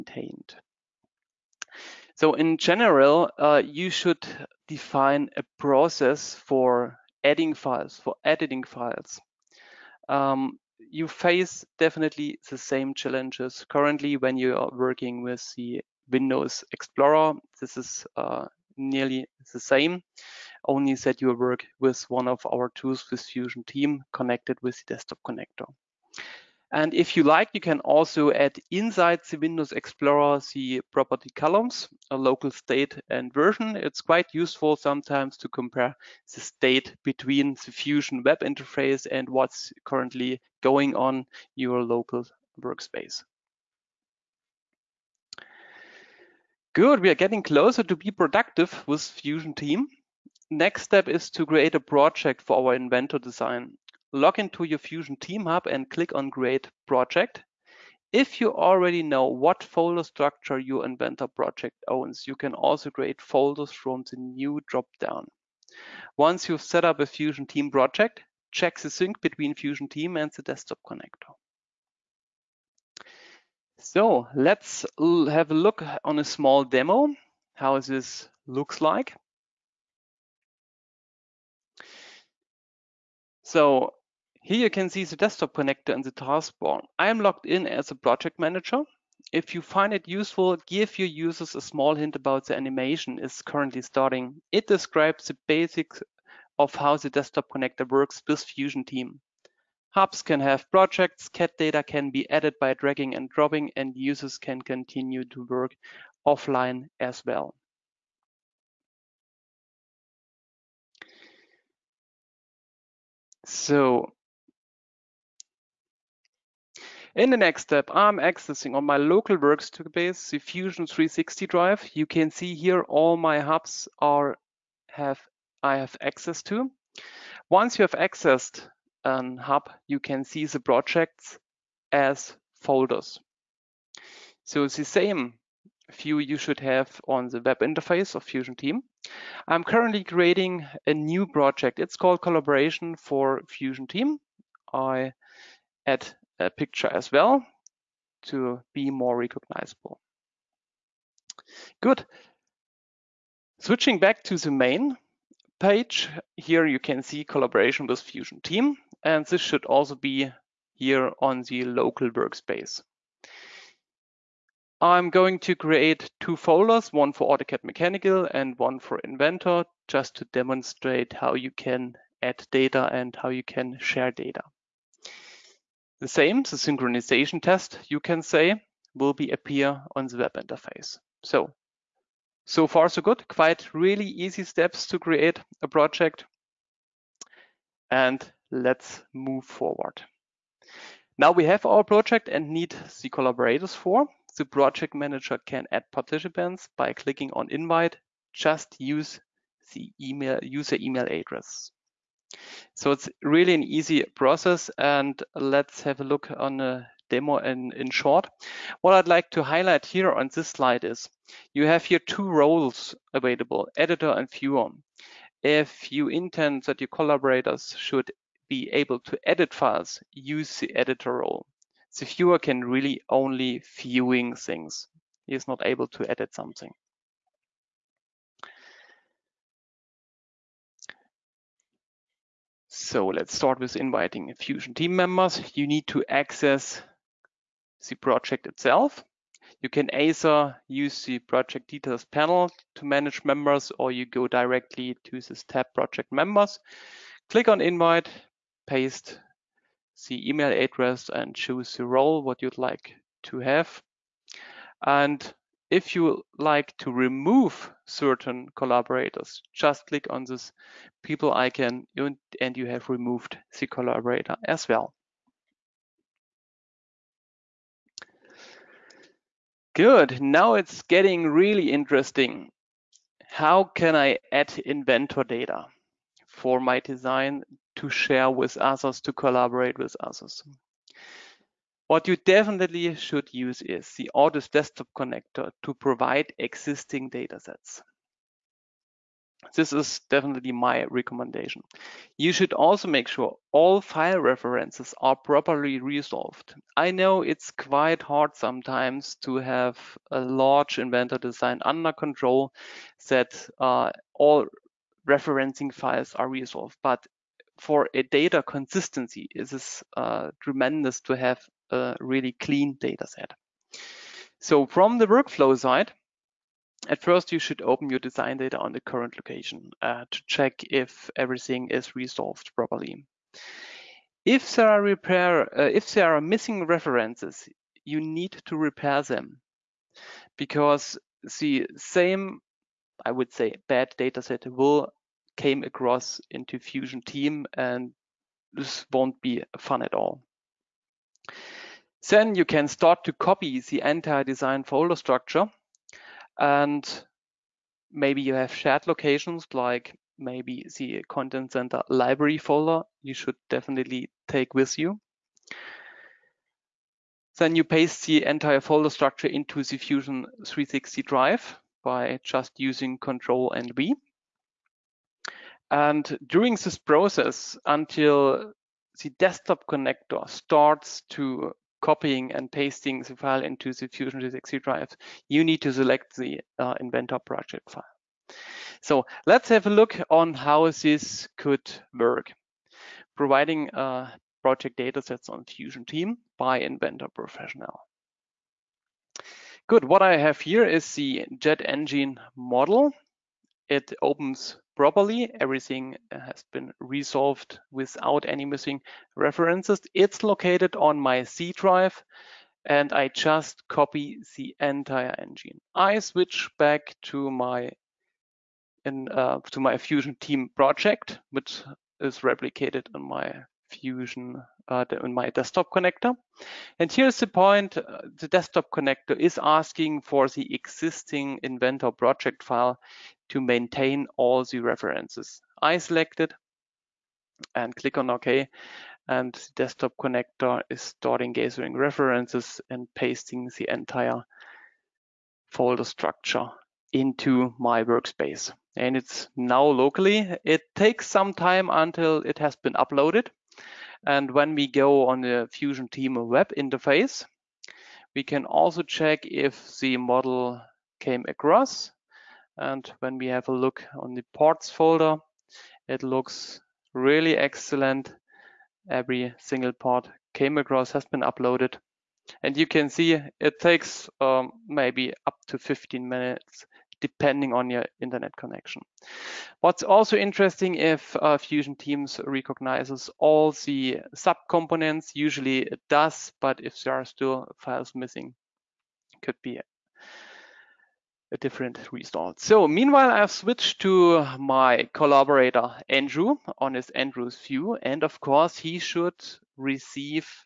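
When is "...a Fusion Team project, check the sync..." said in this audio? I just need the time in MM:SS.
01:07.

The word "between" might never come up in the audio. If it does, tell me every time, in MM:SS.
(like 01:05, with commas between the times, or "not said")
00:37, 01:09.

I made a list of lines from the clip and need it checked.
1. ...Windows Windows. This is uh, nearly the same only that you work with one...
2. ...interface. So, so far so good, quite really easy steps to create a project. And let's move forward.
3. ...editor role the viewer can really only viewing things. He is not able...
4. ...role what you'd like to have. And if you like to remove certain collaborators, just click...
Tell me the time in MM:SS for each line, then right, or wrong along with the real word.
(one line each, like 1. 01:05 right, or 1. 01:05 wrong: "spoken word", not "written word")
1. 00:16 wrong: "Explorer", not "Windows"
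2. 03:00 right
3. 03:40 right
4. 04:11 right.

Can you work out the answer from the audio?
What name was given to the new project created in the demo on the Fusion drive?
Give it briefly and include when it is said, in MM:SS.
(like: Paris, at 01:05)
Collaboration for Fusion Team, at 02:22.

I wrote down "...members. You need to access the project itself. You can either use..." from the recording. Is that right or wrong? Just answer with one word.
right.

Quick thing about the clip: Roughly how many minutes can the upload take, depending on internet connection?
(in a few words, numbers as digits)
15.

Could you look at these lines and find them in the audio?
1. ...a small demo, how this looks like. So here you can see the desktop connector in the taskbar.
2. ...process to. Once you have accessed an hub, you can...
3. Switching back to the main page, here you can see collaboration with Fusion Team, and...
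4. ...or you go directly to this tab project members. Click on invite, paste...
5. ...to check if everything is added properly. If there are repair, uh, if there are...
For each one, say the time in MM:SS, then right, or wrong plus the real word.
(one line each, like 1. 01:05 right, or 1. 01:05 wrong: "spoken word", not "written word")
1. 01:16 right
2. 02:06 wrong: "access", not "process"
3. 02:33 right
4. 04:03 right
5. 05:20 wrong: "resolved", not "added".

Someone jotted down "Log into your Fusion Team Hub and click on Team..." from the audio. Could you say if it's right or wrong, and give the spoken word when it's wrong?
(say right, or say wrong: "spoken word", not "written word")
wrong: "Create", not "Team".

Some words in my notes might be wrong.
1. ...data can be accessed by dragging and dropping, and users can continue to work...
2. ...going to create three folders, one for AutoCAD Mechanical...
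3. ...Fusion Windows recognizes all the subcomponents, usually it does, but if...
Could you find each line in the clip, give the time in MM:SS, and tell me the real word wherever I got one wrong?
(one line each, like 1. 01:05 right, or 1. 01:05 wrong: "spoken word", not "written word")
1. 01:41 wrong: "added", not "accessed"
2. 02:45 wrong: "two", not "three"
3. 07:51 wrong: "Teams", not "Windows".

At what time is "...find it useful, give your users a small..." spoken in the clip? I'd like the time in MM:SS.
01:29.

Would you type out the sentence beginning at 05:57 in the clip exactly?
Then you paste the entire folder structure into the Fusion 360 drive by just using Control and V.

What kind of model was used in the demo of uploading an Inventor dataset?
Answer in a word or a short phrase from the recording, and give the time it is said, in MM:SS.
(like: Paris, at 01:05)
jet engine, at 06:31.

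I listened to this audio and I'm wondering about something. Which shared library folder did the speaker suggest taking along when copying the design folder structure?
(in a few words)
content center library folder.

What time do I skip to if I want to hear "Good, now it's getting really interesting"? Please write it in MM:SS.
04:29.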